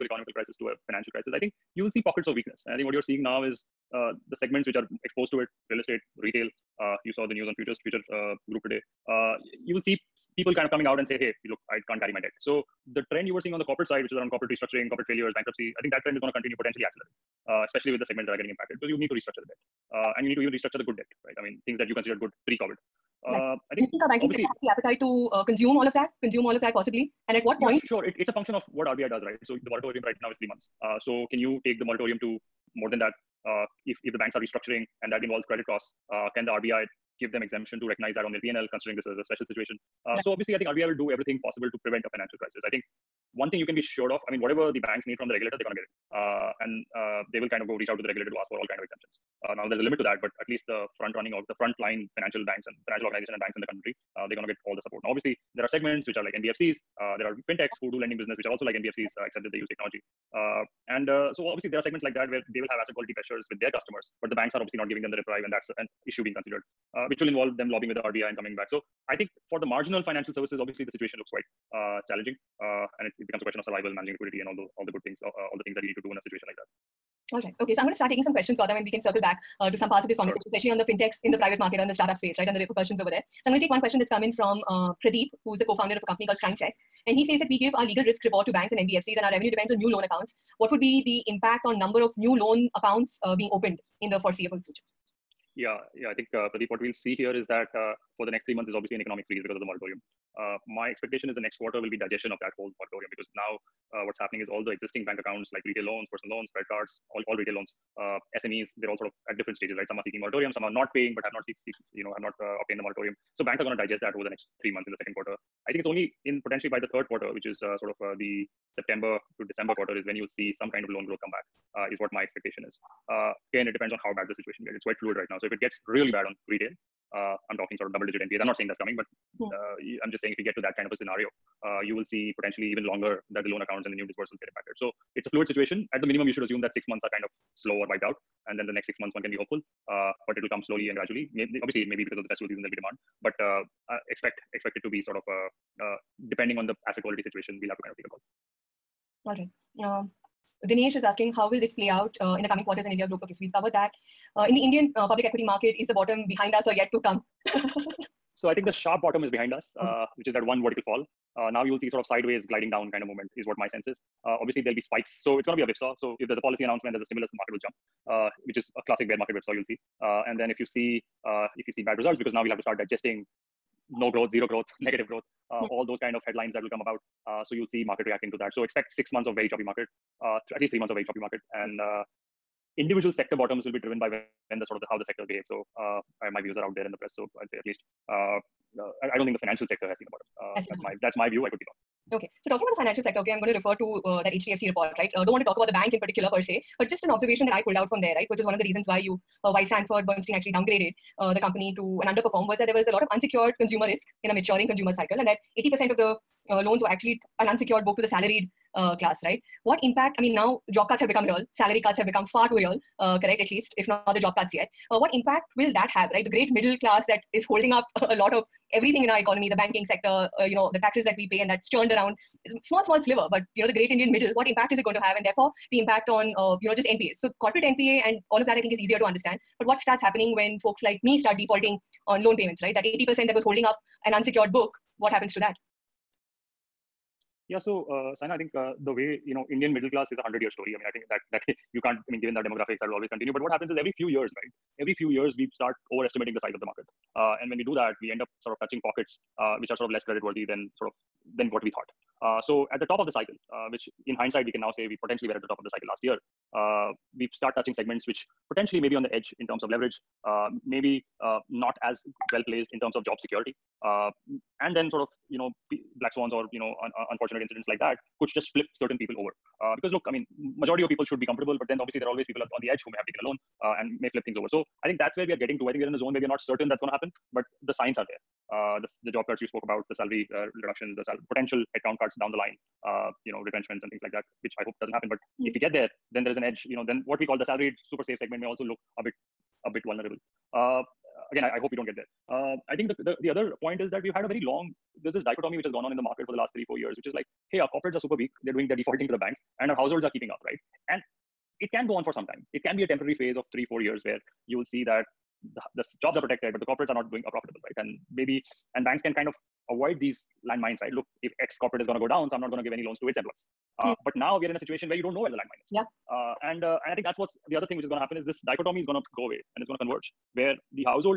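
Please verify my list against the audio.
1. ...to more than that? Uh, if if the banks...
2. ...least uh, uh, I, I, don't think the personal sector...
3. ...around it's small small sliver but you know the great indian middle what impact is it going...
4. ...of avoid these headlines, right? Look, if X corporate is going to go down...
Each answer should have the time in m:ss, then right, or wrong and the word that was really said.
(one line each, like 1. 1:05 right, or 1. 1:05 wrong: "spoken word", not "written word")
1. 0:32 right
2. 3:07 wrong: "financial", not "personal"
3. 3:41 right
4. 5:09 wrong: "landmines", not "headlines".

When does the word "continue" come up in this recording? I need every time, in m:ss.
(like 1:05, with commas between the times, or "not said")
0:16, 4:03.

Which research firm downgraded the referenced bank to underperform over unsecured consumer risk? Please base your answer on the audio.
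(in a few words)
Sanford Bernstein.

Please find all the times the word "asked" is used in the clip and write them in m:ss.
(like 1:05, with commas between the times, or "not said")
not said.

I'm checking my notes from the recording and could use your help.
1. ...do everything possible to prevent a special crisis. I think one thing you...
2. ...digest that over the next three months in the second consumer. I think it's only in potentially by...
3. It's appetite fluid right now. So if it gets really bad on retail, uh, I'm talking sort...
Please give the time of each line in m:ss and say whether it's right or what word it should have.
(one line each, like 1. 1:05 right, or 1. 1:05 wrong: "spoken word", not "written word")
1. 0:40 wrong: "financial", not "special"
2. 1:53 wrong: "quarter", not "consumer"
3. 2:04 wrong: "quite", not "appetite".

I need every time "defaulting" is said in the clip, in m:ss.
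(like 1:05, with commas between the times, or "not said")
3:51, 4:58.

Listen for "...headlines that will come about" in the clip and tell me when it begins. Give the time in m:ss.
2:56.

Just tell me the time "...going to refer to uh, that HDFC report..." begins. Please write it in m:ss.
3:13.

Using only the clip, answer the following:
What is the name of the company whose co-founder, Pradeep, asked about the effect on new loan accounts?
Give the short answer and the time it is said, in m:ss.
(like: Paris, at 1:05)
CrimeCheck, at 1:26.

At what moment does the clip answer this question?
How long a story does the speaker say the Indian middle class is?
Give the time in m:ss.
4:00.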